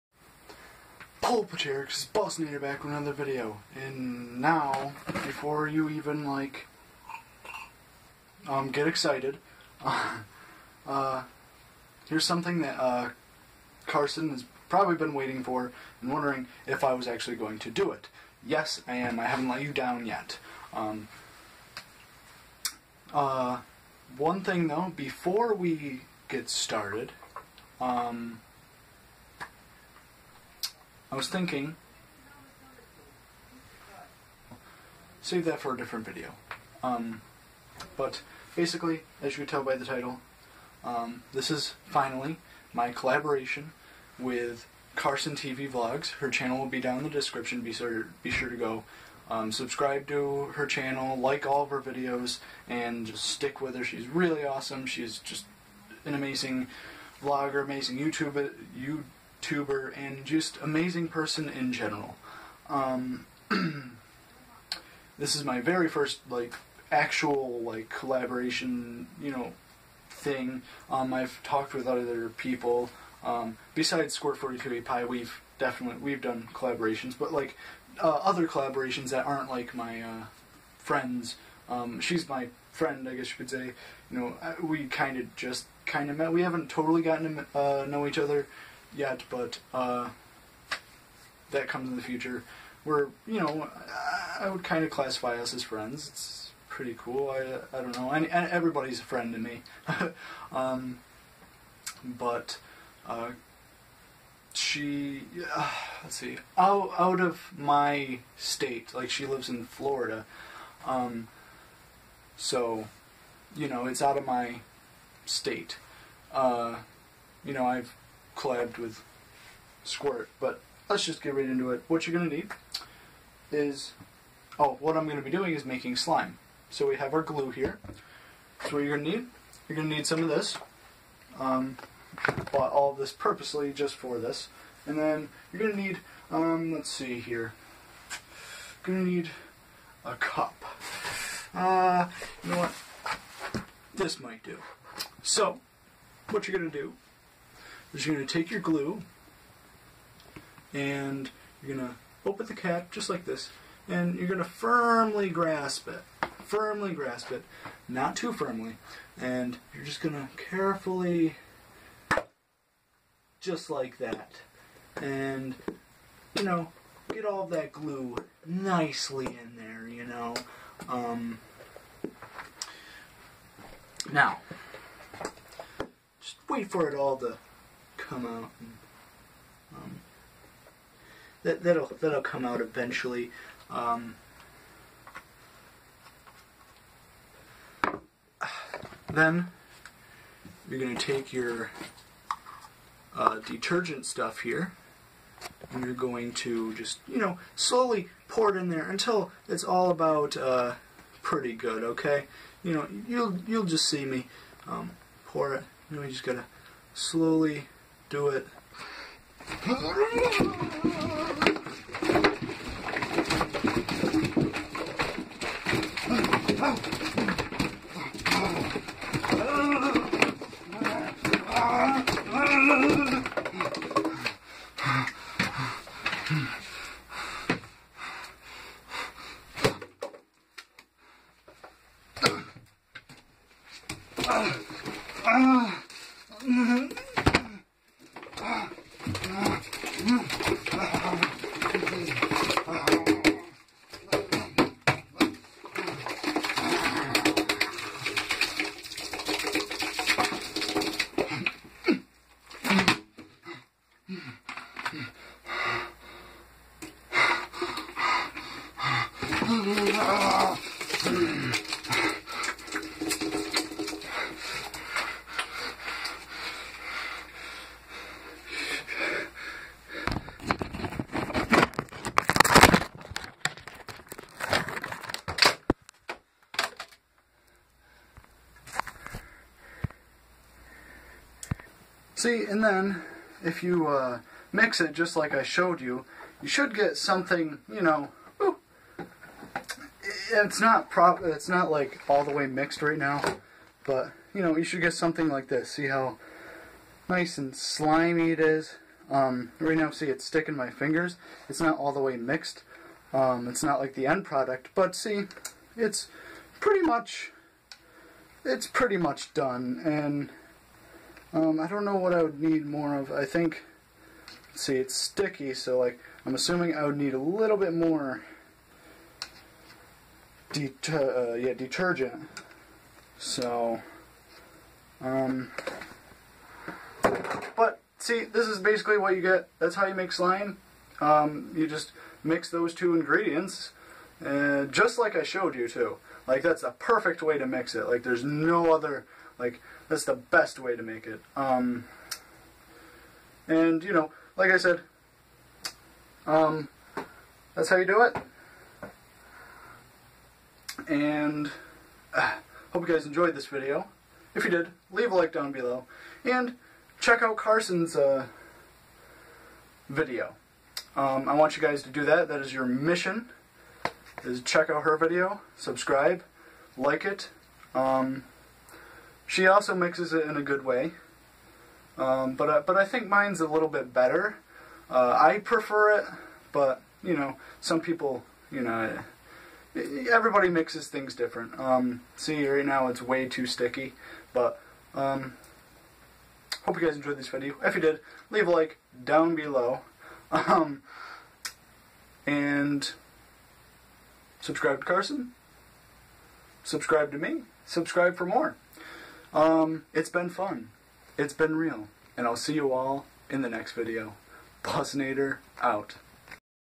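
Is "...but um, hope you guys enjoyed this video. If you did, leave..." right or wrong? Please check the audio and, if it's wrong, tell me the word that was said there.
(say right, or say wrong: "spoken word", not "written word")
right.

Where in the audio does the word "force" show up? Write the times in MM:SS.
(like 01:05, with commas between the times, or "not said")
not said.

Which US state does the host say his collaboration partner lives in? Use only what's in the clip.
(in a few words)
Florida.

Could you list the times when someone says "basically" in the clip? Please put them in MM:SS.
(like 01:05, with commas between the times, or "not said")
00:38, 05:28.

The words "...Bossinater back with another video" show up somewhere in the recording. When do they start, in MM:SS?
00:02.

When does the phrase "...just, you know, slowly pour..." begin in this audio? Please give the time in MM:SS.
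03:16.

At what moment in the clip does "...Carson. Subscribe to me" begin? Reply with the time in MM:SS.
06:34.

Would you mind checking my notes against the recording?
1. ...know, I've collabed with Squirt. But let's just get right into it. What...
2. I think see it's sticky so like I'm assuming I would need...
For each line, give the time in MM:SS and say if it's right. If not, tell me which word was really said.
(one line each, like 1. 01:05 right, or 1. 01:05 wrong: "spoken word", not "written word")
1. 01:57 right
2. 05:13 right.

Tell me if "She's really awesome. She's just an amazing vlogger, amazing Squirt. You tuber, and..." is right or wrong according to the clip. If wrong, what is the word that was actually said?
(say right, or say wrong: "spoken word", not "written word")
wrong: "YouTuber", not "Squirt".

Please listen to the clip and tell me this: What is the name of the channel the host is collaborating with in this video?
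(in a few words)
Carson TV Vlogs.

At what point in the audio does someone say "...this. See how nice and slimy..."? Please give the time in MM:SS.
04:55.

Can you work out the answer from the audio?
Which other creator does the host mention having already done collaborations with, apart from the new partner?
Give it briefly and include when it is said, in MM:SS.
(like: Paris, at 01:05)
Score 42 Pi, at 01:14.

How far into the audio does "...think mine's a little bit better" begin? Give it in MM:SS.
06:12.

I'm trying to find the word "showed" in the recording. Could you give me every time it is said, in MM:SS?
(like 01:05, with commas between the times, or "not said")
04:45, 05:35.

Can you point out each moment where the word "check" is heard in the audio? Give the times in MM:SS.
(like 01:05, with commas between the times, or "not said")
05:56, 06:04.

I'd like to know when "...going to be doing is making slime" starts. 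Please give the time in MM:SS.
02:05.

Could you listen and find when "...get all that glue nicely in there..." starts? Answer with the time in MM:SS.
02:47.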